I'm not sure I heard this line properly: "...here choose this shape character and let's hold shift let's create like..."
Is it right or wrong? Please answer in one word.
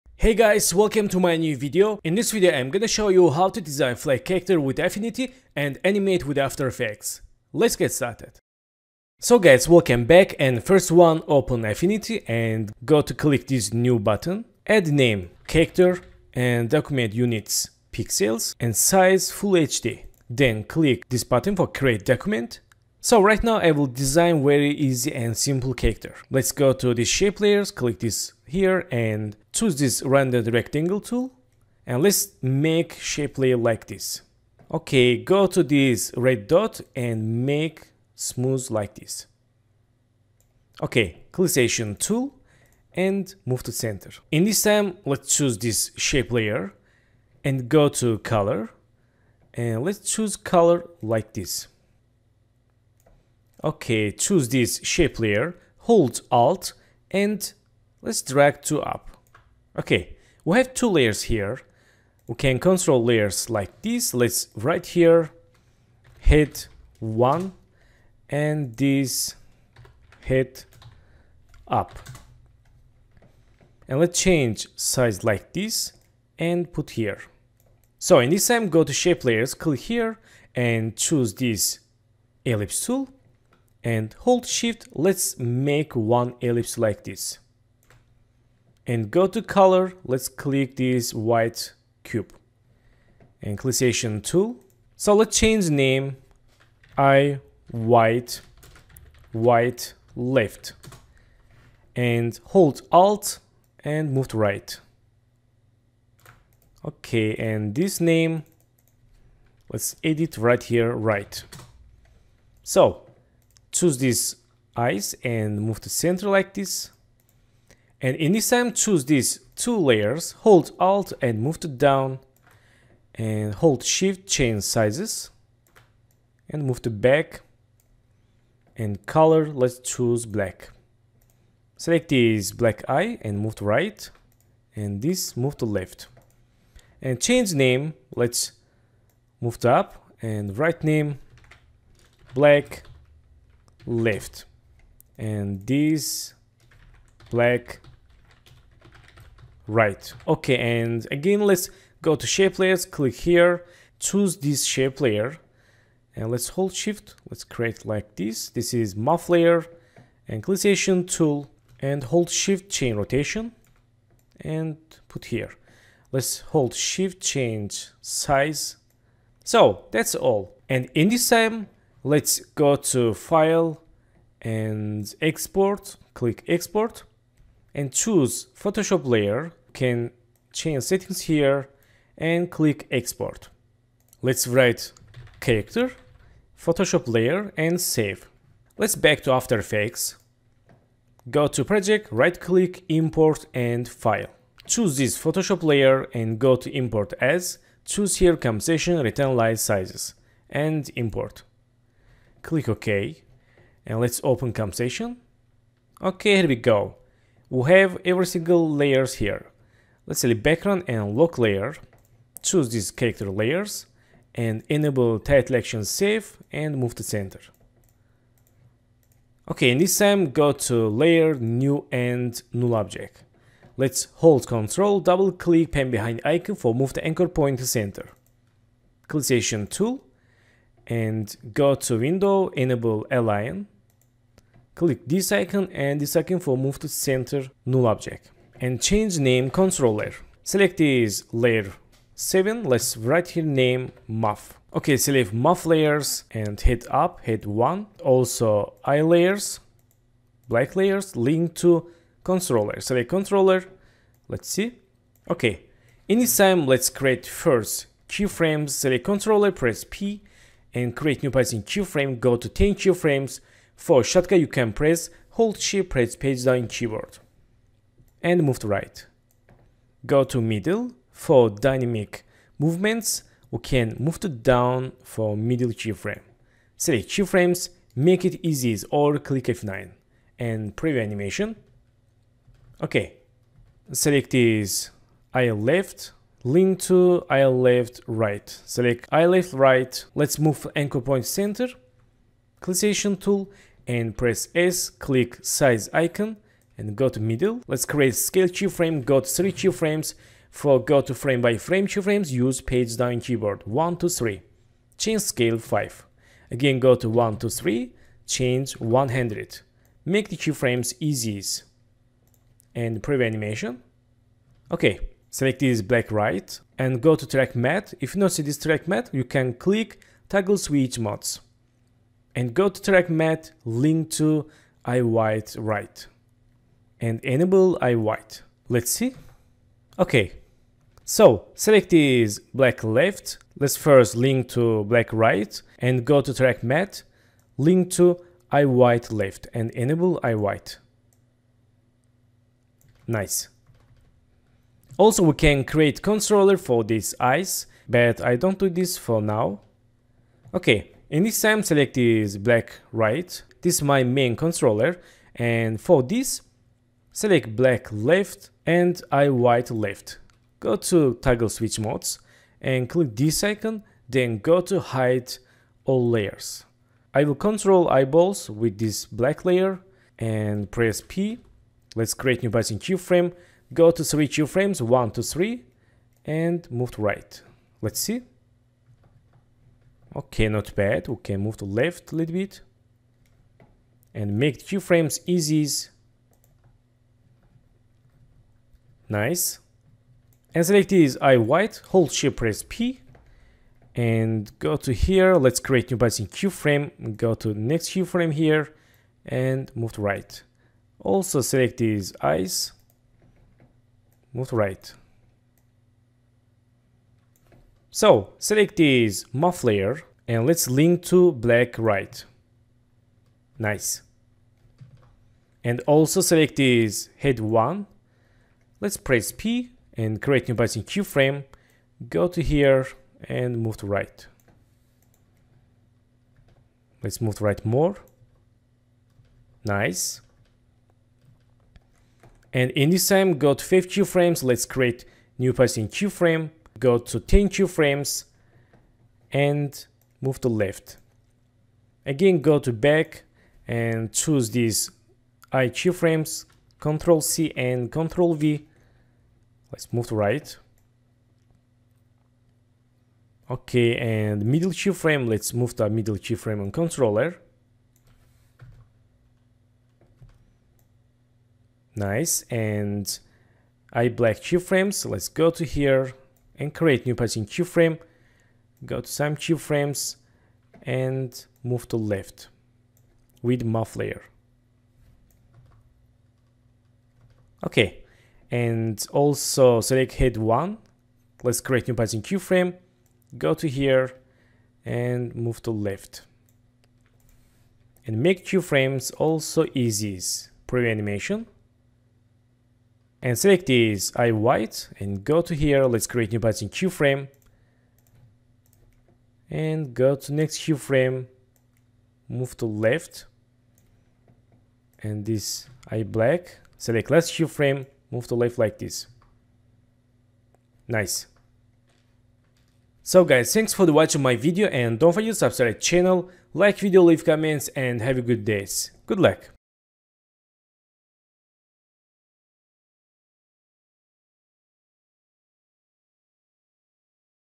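wrong.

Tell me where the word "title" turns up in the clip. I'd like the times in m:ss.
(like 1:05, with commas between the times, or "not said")
3:35.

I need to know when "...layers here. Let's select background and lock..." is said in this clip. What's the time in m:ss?
3:28.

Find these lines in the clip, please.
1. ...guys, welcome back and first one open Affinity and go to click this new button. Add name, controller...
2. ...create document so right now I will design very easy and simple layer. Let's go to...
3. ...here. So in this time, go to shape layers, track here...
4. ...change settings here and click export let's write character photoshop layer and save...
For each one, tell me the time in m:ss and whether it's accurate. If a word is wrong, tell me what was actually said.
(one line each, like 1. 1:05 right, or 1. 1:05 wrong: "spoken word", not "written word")
1. 0:09 wrong: "character", not "controller"
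2. 0:21 wrong: "character", not "layer"
3. 1:16 wrong: "click", not "track"
4. 3:00 right.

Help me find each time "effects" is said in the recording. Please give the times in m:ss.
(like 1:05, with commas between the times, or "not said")
0:06, 3:09.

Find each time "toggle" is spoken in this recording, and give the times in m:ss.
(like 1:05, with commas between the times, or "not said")
5:20, 6:01.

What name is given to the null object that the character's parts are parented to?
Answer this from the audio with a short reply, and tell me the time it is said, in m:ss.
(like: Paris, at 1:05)
control layer, at 3:58.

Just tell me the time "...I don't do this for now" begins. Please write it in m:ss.
5:48.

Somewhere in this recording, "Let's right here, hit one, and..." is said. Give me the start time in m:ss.
1:04.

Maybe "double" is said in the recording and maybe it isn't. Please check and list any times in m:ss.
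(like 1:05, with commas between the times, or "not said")
3:45.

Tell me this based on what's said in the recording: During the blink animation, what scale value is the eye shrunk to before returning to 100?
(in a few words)
5.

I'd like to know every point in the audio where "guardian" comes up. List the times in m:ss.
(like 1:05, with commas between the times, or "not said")
not said.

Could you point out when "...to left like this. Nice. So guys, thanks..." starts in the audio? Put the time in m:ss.
8:28.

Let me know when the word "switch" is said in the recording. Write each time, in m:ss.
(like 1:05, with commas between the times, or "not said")
5:20, 6:01.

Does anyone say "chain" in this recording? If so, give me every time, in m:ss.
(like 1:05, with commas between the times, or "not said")
2:42.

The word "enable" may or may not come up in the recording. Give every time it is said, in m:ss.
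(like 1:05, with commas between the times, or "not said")
3:34, 3:52, 5:27, 5:39.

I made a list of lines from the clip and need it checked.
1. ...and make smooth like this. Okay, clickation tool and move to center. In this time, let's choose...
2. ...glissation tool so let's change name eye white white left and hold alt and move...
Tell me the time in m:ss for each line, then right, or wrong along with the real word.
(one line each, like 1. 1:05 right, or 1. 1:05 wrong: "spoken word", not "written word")
1. 0:36 right
2. 1:33 right.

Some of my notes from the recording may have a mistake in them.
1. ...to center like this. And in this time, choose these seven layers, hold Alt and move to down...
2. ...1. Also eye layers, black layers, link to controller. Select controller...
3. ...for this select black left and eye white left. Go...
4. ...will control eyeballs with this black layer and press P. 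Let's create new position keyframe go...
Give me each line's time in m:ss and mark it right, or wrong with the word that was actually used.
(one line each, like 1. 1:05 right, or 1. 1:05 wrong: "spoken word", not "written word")
1. 1:55 wrong: "two", not "seven"
2. 4:07 right
3. 5:55 right
4. 6:07 right.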